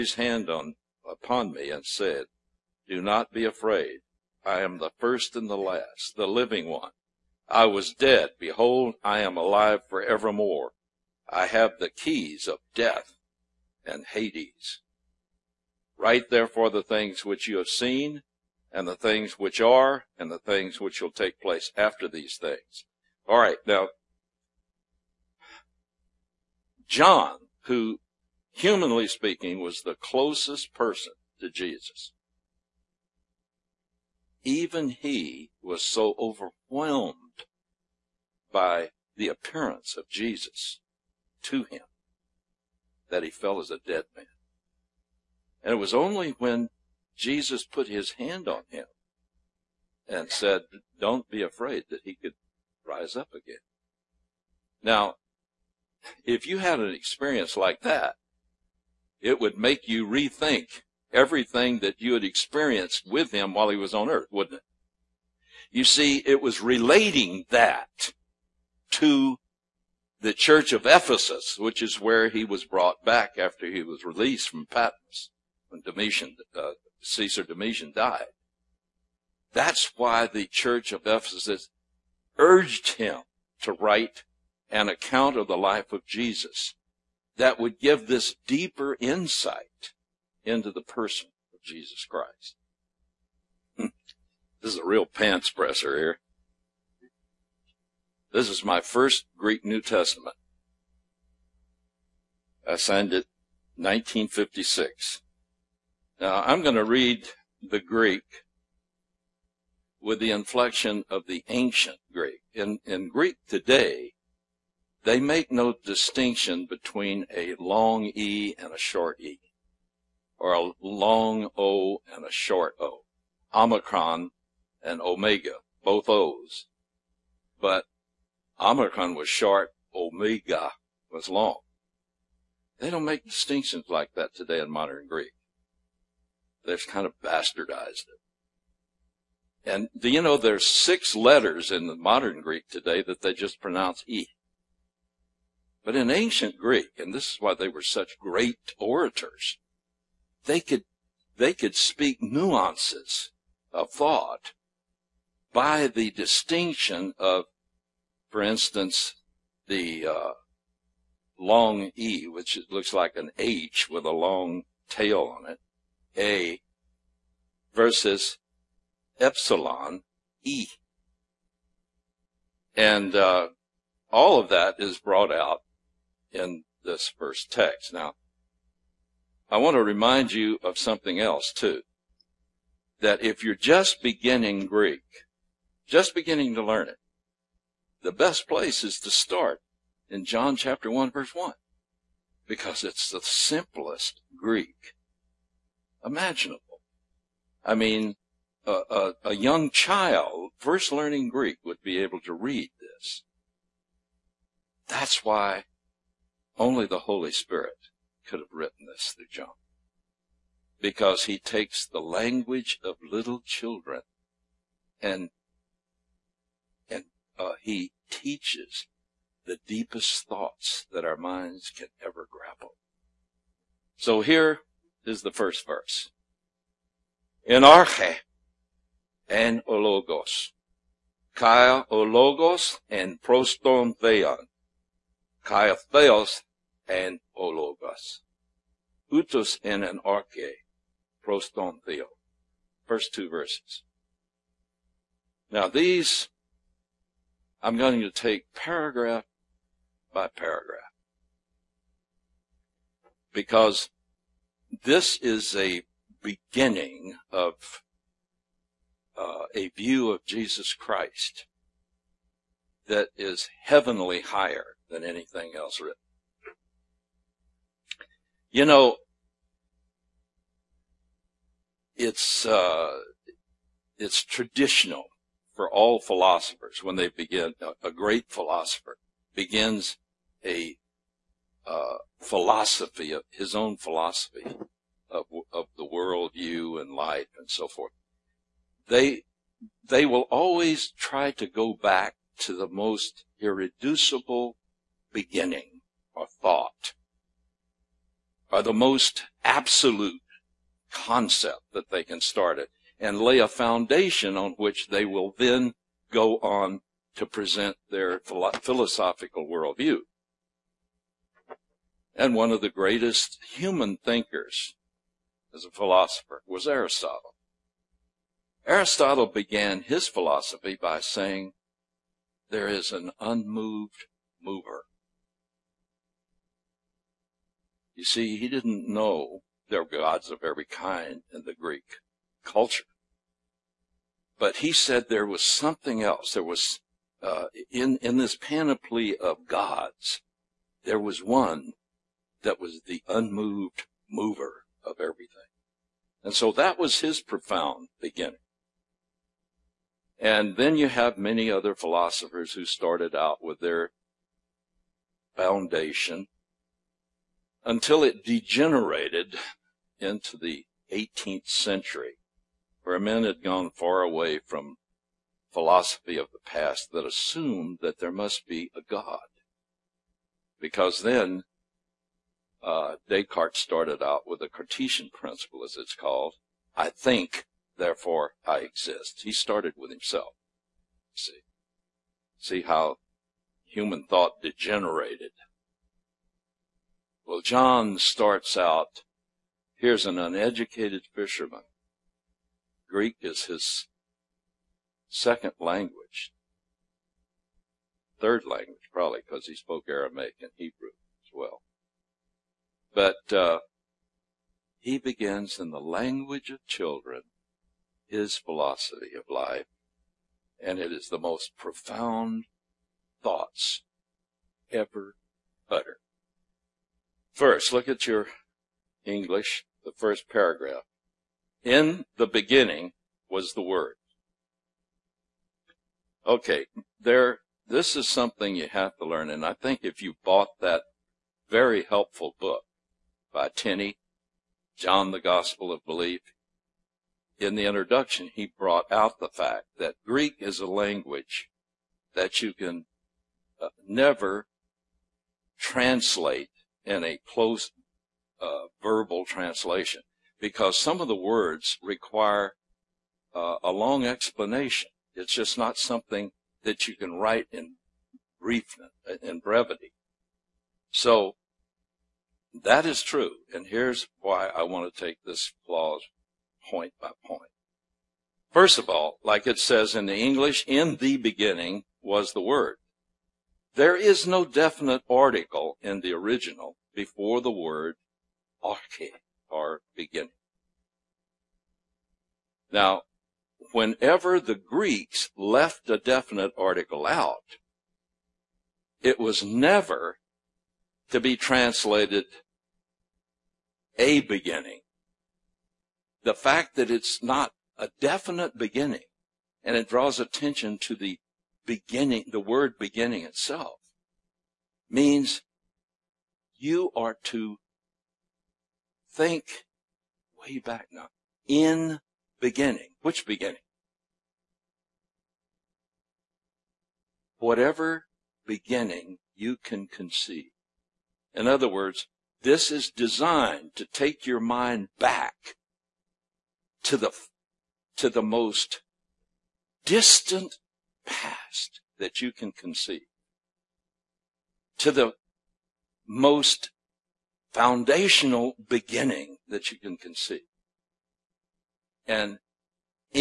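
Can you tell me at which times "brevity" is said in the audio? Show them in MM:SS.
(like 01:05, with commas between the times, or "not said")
07:39.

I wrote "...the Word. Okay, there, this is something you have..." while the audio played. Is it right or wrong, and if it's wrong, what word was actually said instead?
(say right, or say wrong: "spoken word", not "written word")
right.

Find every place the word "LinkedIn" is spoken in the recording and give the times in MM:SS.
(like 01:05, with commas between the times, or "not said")
not said.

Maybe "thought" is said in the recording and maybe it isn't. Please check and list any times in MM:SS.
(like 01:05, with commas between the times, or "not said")
02:33, 03:40, 04:56, 06:24, 06:53.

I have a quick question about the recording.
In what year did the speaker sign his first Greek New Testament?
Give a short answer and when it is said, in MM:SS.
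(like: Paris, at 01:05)
1956, at 01:43.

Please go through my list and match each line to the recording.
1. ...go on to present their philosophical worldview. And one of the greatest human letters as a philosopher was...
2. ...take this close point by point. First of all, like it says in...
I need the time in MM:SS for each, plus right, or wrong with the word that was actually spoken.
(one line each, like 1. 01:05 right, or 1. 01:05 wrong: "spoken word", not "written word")
1. 05:06 wrong: "thinkers", not "letters"
2. 07:45 wrong: "clause", not "close".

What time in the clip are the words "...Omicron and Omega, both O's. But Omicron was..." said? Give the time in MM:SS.
02:03.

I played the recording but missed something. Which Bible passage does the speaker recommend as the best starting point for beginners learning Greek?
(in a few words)
John 1:1.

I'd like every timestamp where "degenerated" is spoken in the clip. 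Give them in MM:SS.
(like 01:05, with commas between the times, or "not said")
05:58, 06:24.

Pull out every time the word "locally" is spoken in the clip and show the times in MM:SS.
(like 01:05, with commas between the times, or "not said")
not said.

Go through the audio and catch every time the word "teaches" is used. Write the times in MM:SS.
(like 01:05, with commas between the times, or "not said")
03:38.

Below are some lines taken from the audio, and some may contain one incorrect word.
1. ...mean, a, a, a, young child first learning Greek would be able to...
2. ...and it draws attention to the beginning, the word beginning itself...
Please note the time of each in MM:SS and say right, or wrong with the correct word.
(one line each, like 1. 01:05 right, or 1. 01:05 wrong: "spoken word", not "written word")
1. 03:17 right
2. 08:19 right.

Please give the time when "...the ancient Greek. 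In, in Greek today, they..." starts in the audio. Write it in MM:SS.
01:51.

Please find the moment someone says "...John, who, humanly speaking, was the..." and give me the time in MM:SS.
00:26.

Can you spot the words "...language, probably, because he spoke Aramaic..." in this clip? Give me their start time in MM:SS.
06:38.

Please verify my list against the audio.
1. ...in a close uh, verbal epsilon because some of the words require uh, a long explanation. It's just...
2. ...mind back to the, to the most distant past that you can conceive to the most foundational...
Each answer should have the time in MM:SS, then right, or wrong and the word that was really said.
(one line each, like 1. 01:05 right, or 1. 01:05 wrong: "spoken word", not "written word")
1. 07:26 wrong: "translation", not "epsilon"
2. 08:44 right.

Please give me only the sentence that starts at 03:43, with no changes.
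So here is the first verse.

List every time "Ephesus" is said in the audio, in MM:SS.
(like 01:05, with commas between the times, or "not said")
01:10, 01:21.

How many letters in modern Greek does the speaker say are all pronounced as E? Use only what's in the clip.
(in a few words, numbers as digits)
6.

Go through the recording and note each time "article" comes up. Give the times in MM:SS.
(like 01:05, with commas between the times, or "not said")
07:55, 08:06.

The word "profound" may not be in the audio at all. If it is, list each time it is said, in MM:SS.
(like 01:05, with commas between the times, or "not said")
05:47, 06:51.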